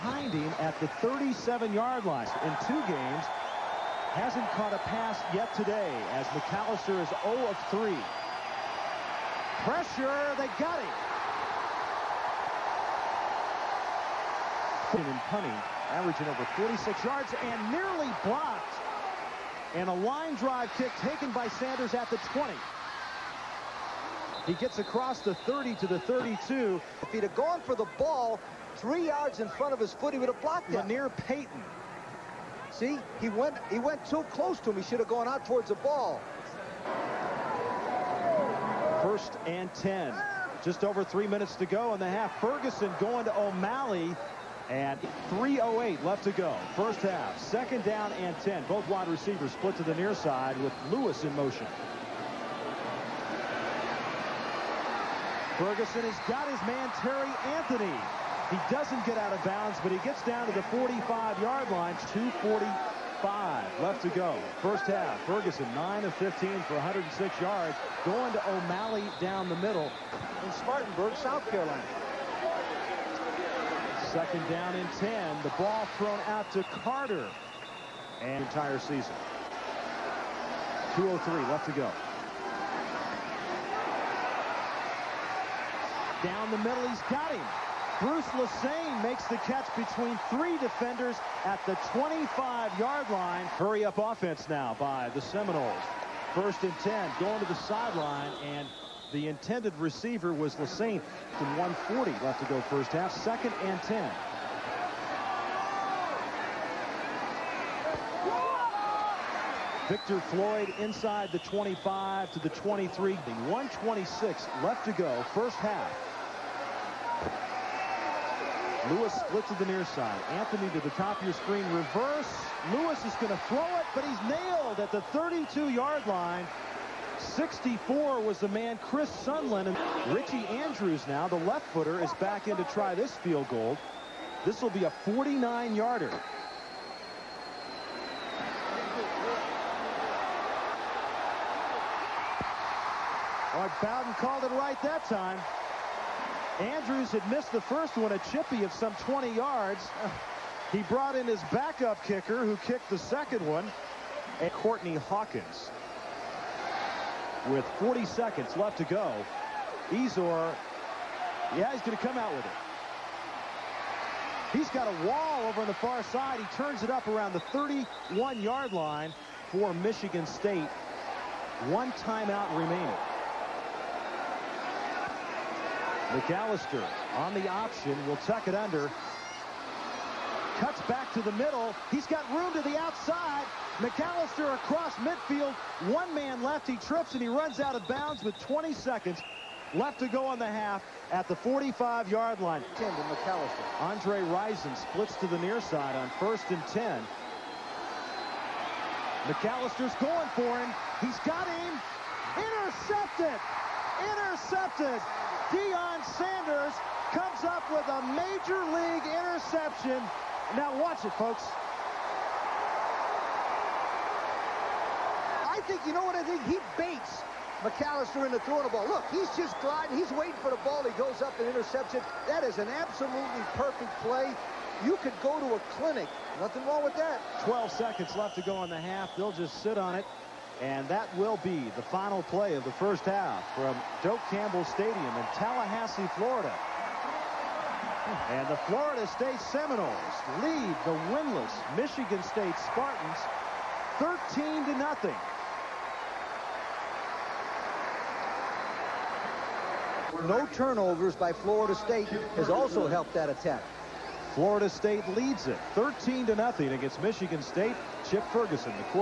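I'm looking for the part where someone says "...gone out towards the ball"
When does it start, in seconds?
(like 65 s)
35 s.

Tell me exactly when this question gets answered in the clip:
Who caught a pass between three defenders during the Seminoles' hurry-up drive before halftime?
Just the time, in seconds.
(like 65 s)
87 s.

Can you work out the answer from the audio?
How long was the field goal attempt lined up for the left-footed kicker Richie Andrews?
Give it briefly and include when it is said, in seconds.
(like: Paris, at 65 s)
49 yards, at 135 s.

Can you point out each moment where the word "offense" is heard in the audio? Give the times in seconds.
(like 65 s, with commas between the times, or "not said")
93 s.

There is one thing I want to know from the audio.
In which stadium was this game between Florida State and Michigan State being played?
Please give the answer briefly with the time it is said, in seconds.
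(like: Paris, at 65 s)
Doak Campbell Stadium, at 234 s.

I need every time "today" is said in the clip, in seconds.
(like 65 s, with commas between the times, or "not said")
5 s.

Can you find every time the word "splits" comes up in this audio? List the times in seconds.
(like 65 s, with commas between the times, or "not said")
49 s, 119 s, 194 s.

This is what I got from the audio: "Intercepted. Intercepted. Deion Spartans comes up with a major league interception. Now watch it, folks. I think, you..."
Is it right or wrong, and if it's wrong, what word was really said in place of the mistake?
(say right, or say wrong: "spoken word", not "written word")
wrong: "Sanders", not "Spartans".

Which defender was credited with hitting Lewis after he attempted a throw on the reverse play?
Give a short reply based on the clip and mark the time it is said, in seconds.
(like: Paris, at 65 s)
Chris Sunland, at 128 s.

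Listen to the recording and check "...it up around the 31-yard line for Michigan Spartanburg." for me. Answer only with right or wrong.
wrong.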